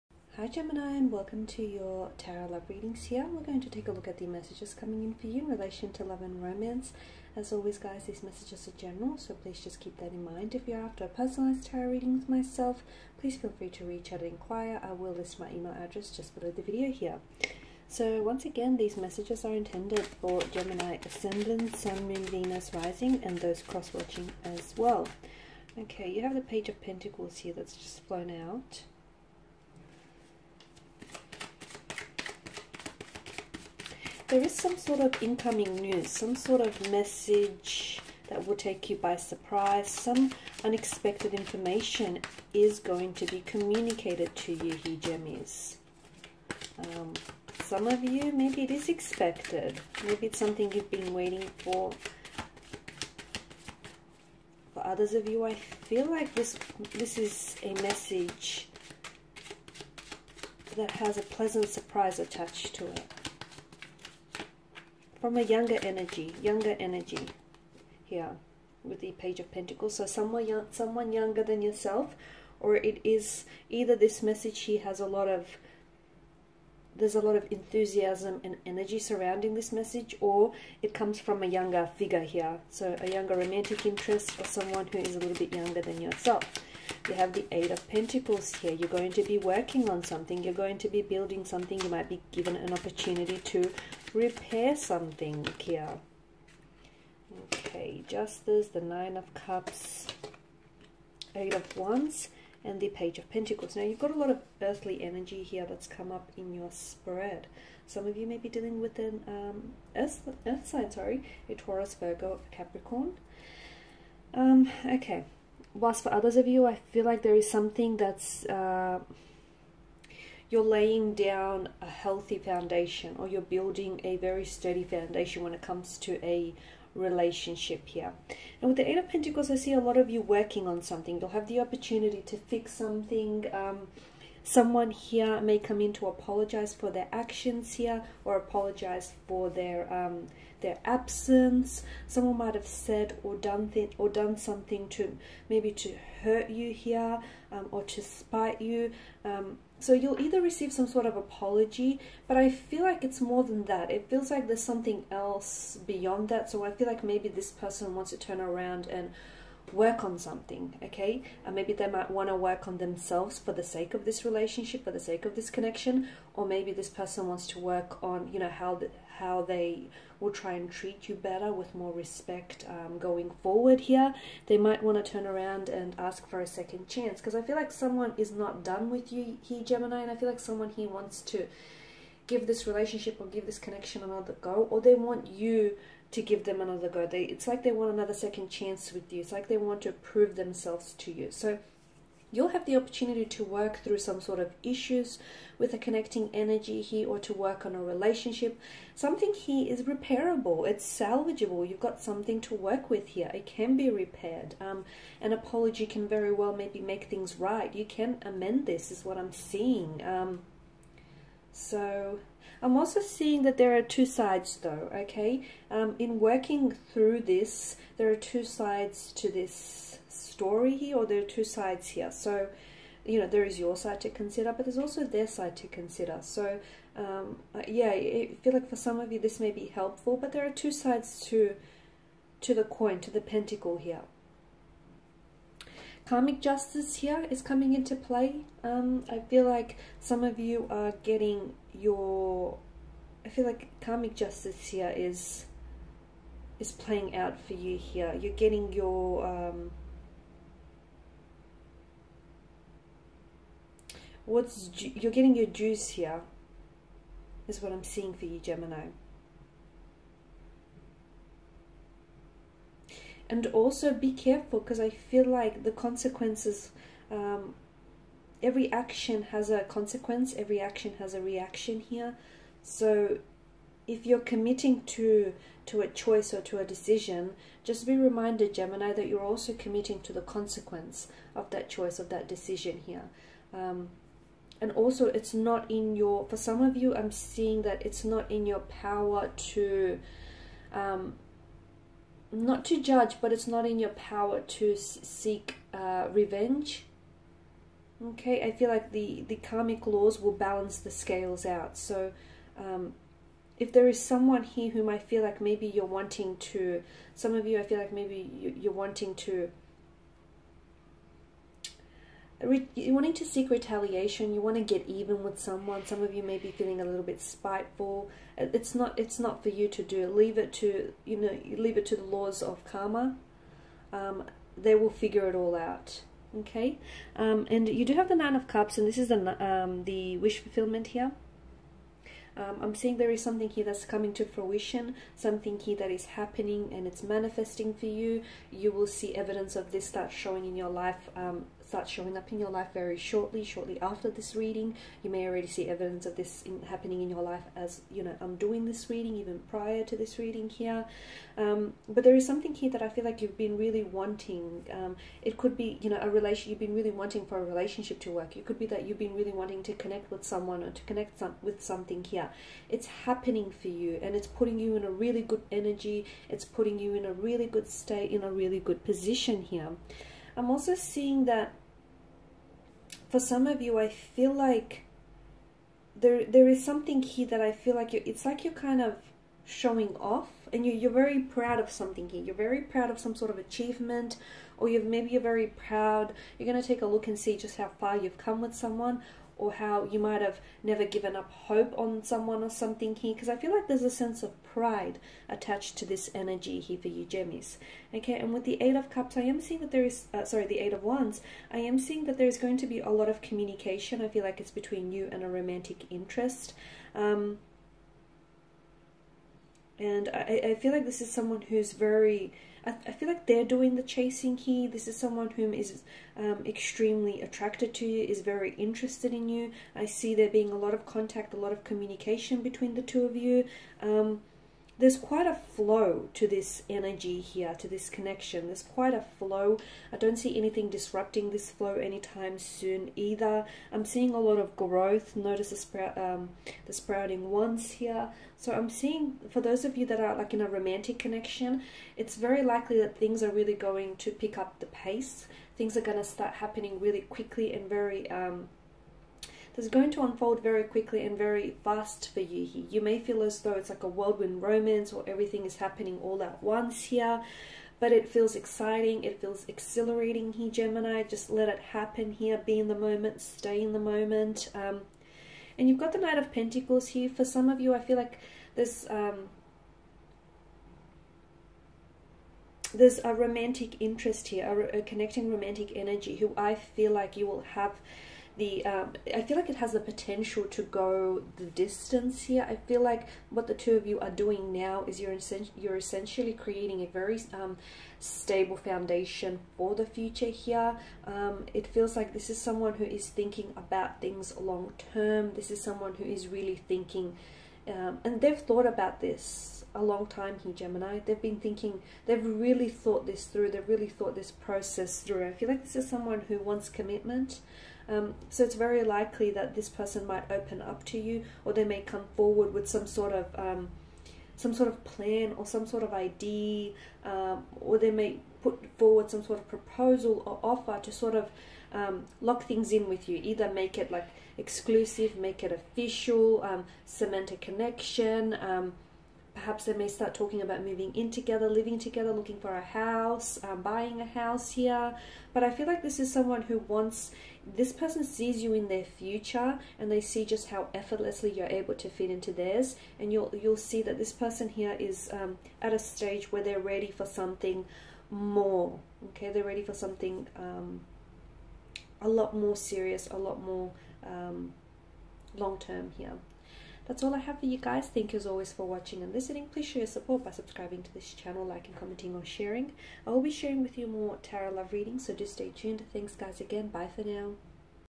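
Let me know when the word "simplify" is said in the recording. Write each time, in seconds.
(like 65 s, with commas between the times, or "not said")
not said.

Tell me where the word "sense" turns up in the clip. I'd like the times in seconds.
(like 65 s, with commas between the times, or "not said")
393 s.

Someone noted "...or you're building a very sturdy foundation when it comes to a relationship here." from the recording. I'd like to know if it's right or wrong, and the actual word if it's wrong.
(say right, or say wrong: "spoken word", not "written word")
right.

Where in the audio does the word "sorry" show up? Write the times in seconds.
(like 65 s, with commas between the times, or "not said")
110 s, 400 s.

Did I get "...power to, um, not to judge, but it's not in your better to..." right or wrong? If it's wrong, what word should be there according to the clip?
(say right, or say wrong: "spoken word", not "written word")
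wrong: "power", not "better".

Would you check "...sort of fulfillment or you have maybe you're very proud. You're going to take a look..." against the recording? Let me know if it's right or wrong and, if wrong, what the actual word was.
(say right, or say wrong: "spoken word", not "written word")
wrong: "achievement", not "fulfillment".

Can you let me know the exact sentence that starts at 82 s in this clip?
So a younger romantic interest or someone who is a little bit younger than yourself.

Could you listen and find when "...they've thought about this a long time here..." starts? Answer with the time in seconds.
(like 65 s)
498 s.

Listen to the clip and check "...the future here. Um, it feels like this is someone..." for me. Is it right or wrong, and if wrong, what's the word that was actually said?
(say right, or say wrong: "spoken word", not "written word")
right.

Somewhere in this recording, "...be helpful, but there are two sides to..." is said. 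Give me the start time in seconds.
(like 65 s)
229 s.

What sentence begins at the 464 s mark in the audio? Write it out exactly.
Um, and you've got the Knight of Pentacles here.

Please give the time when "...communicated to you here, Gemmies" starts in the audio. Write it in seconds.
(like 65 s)
43 s.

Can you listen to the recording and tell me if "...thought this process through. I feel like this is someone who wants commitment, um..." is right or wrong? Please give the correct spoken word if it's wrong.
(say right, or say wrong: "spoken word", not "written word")
right.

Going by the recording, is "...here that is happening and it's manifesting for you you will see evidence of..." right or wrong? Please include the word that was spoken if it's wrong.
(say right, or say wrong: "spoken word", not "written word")
right.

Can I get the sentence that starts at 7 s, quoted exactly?
As always guys, these messages are general, so please just keep that in mind.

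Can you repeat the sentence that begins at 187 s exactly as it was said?
They, it's like they want another second chance with you.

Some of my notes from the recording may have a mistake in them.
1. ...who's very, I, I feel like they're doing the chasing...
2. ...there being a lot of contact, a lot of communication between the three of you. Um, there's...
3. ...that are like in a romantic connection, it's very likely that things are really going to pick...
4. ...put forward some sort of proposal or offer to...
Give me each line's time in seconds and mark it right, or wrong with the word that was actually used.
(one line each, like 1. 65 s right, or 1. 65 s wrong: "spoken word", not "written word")
1. 411 s right
2. 420 s wrong: "two", not "three"
3. 439 s right
4. 518 s right.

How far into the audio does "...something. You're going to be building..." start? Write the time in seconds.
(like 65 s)
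90 s.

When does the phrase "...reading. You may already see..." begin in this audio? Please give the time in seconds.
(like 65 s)
344 s.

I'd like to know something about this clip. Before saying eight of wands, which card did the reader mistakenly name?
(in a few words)
Eight of Cups.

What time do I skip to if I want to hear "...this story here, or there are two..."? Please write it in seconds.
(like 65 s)
219 s.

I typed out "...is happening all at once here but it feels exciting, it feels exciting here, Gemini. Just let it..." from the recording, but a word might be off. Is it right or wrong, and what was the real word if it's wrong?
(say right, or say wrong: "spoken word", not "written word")
wrong: "exhilarating", not "exciting".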